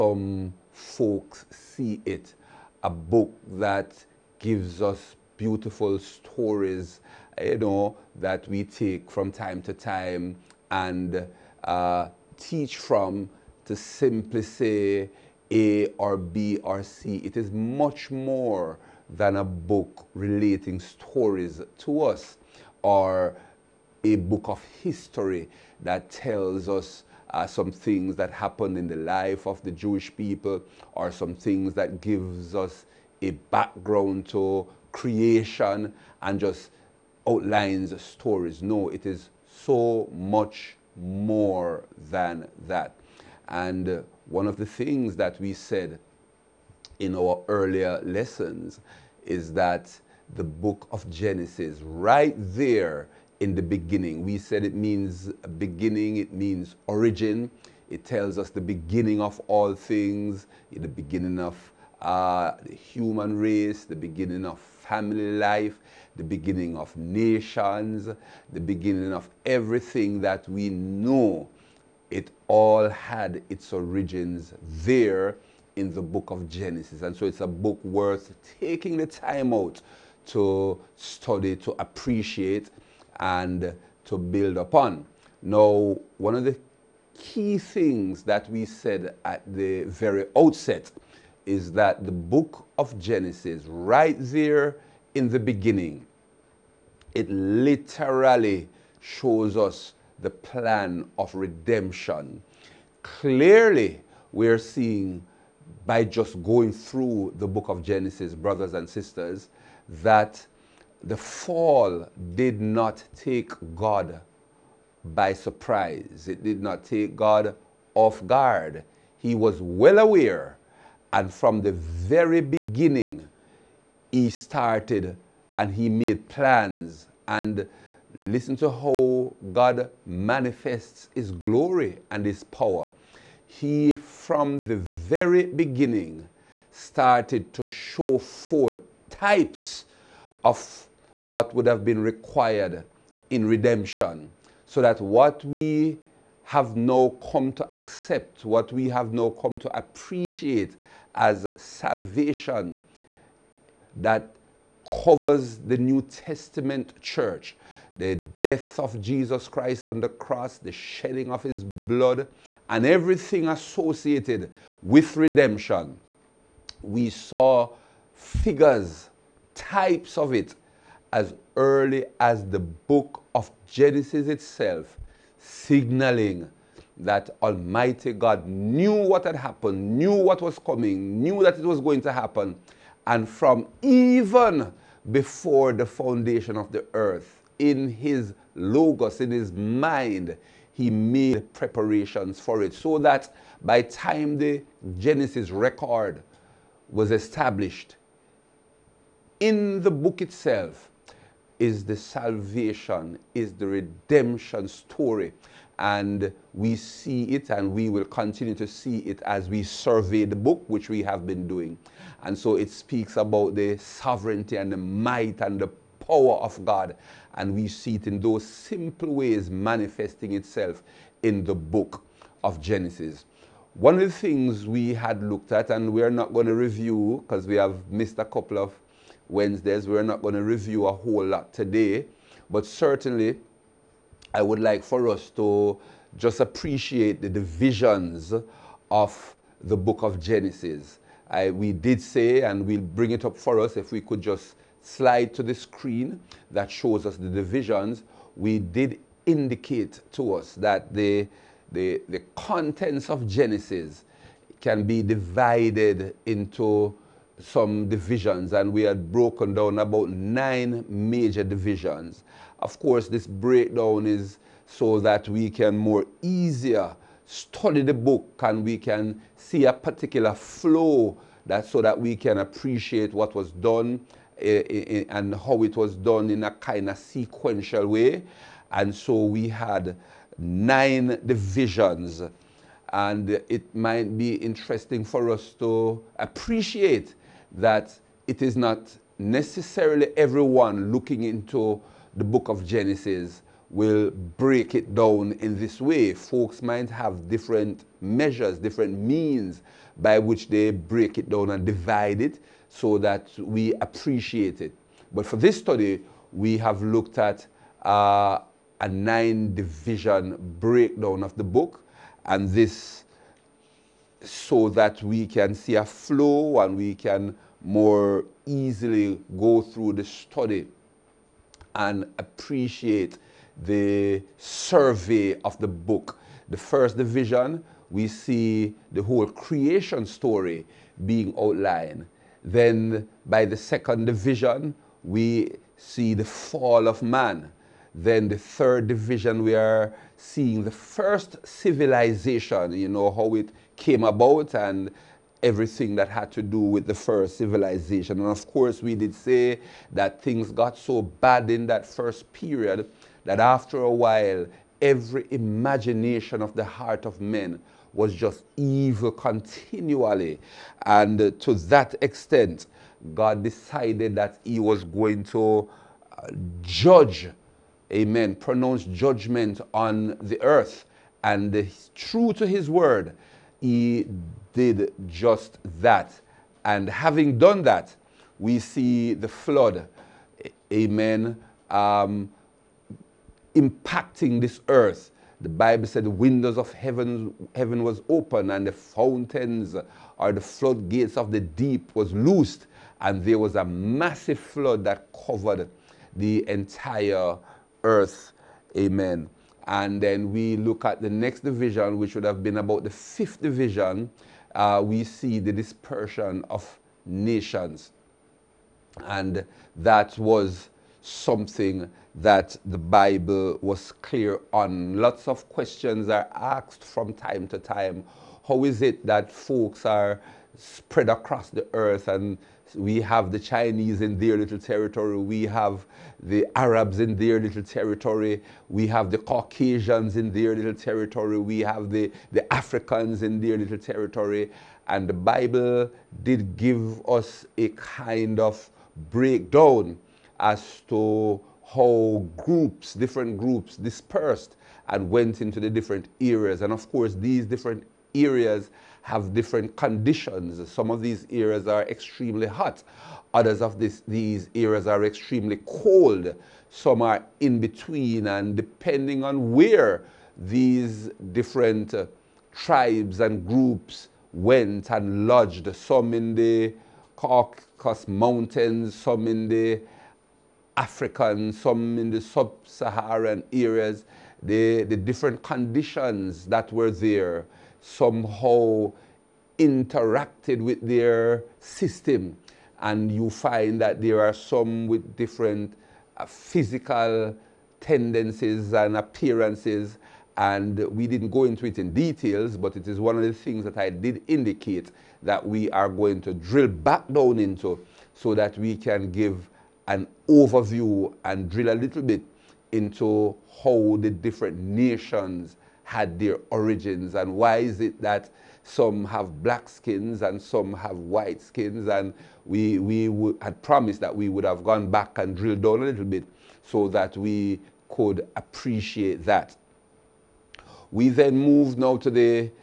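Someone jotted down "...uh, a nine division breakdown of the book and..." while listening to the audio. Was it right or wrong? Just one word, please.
right.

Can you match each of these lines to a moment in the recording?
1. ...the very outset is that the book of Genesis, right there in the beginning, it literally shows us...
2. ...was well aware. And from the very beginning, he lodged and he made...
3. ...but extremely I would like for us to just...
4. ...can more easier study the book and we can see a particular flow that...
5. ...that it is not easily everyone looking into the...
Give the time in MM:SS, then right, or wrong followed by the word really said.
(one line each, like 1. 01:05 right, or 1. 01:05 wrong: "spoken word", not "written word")
1. 01:29 right
2. 01:59 wrong: "started", not "lodged"
3. 03:52 wrong: "certainly", not "extremely"
4. 04:25 right
5. 04:47 wrong: "necessarily", not "easily".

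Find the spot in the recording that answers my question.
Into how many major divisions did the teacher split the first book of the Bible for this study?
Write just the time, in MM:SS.
04:20.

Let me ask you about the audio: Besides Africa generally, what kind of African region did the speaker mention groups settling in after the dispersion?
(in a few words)
Sub-Saharan areas.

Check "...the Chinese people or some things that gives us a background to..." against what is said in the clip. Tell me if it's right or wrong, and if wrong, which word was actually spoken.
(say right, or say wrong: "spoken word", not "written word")
wrong: "Jewish", not "Chinese".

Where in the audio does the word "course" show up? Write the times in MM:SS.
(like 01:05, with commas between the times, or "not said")
04:22, 05:48, 07:26.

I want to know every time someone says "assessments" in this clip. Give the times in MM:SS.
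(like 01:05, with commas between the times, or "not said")
not said.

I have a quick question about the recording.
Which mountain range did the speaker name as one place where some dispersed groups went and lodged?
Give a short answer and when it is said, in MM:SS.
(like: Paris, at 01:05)
Caucasus Mountains, at 07:47.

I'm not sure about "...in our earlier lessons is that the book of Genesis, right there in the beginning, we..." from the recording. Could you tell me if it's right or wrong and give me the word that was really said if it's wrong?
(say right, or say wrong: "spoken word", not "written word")
right.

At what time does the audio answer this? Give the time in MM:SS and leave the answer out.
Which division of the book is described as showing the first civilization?
05:38.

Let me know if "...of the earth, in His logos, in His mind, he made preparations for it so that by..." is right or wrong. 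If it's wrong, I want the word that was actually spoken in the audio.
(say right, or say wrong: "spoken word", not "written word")
right.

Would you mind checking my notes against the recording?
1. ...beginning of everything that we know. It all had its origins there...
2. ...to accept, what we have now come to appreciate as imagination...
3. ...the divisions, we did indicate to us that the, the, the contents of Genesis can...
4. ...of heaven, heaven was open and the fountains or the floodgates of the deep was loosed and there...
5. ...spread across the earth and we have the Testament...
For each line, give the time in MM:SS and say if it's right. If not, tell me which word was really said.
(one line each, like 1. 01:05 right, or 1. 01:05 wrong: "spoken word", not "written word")
1. 01:08 right
2. 02:27 wrong: "salvation", not "imagination"
3. 04:07 right
4. 06:26 right
5. 07:00 wrong: "Chinese", not "Testament".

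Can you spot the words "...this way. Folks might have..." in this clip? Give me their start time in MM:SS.
04:55.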